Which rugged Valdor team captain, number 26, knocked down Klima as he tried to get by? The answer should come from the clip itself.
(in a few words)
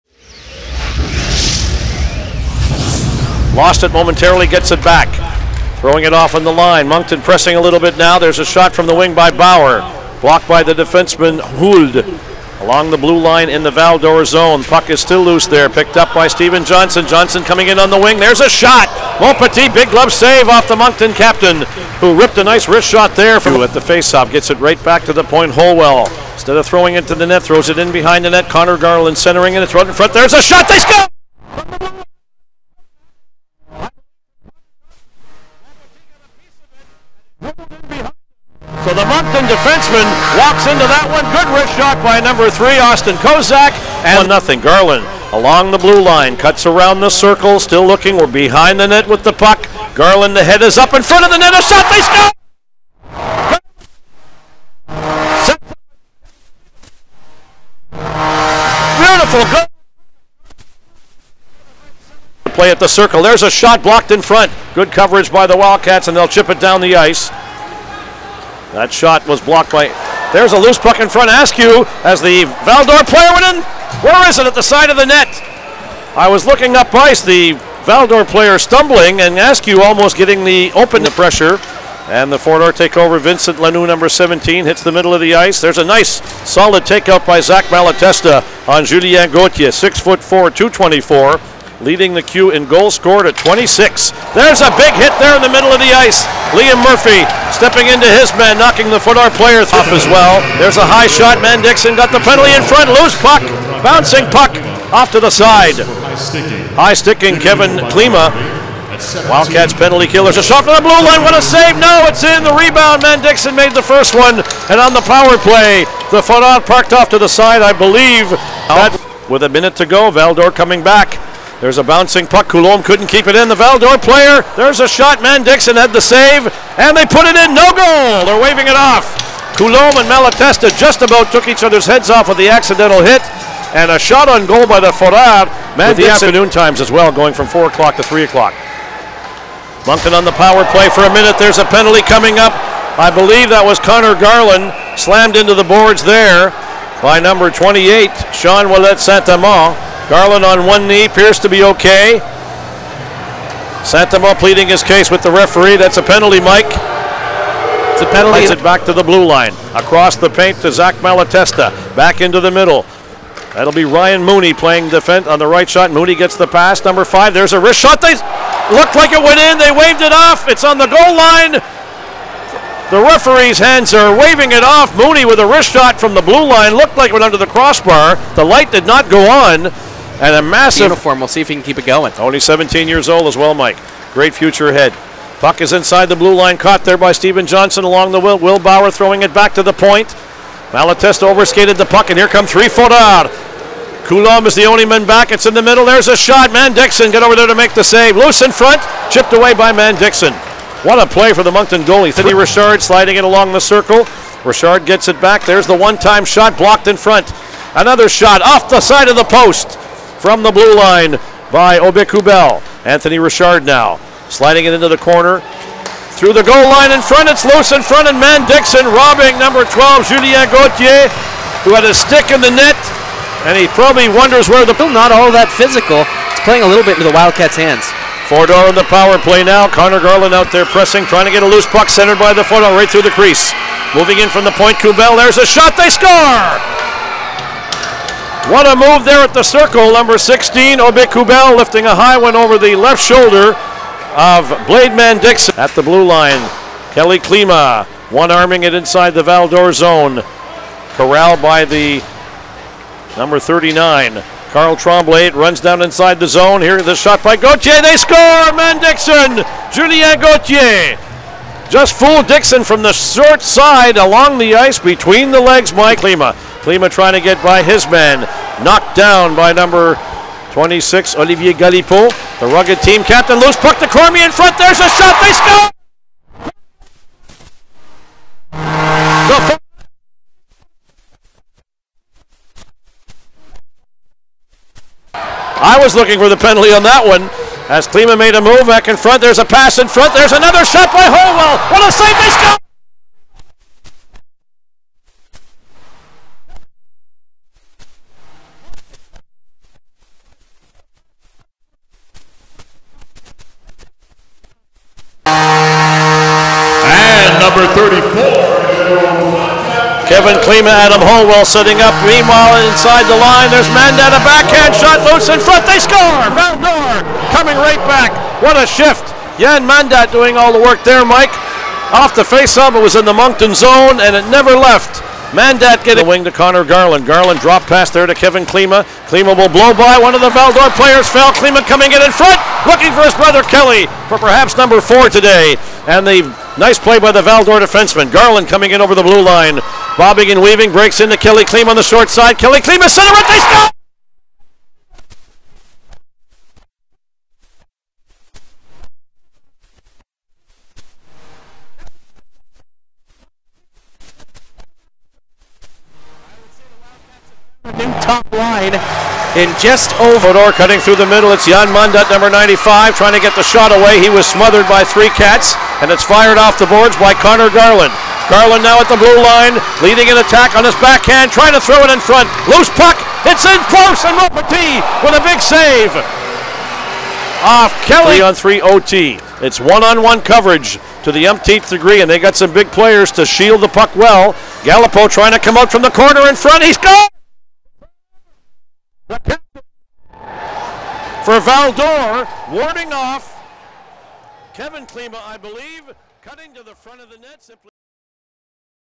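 Olivier Galipeau.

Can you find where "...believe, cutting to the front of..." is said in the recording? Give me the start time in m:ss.
6:35.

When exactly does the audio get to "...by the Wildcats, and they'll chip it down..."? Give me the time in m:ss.
1:05.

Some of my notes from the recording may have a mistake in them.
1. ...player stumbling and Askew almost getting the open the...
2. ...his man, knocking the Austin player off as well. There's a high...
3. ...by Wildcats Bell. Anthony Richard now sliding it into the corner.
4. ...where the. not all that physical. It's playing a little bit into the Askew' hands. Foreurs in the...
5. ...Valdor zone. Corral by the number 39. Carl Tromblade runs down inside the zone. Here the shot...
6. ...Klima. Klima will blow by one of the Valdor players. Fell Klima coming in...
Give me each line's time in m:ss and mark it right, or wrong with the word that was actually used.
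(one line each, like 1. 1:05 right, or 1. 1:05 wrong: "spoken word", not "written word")
1. 1:18 right
2. 1:38 wrong: "Foreurs", not "Austin"
3. 3:31 wrong: "Obiku", not "Wildcats"
4. 3:44 wrong: "Wildcats", not "Askew"
5. 4:09 right
6. 5:28 right.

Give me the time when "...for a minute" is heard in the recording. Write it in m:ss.
2:20.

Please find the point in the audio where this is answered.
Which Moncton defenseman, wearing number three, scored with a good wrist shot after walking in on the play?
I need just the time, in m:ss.
0:42.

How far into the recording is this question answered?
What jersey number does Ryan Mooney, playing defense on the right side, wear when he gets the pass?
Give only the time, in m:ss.
2:46.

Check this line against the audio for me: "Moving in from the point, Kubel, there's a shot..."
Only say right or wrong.
right.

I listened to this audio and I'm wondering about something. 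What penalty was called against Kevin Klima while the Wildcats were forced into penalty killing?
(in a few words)
High sticking.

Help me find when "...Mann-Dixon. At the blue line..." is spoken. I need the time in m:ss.
4:04.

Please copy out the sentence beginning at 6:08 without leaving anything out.
Garland now at the blue line, leading an attack on his backhand, trying to throw it in front.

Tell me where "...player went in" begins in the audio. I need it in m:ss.
1:13.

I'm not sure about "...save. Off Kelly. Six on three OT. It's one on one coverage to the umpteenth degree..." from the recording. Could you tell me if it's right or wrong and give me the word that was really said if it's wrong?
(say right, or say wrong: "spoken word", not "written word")
wrong: "Three", not "Six".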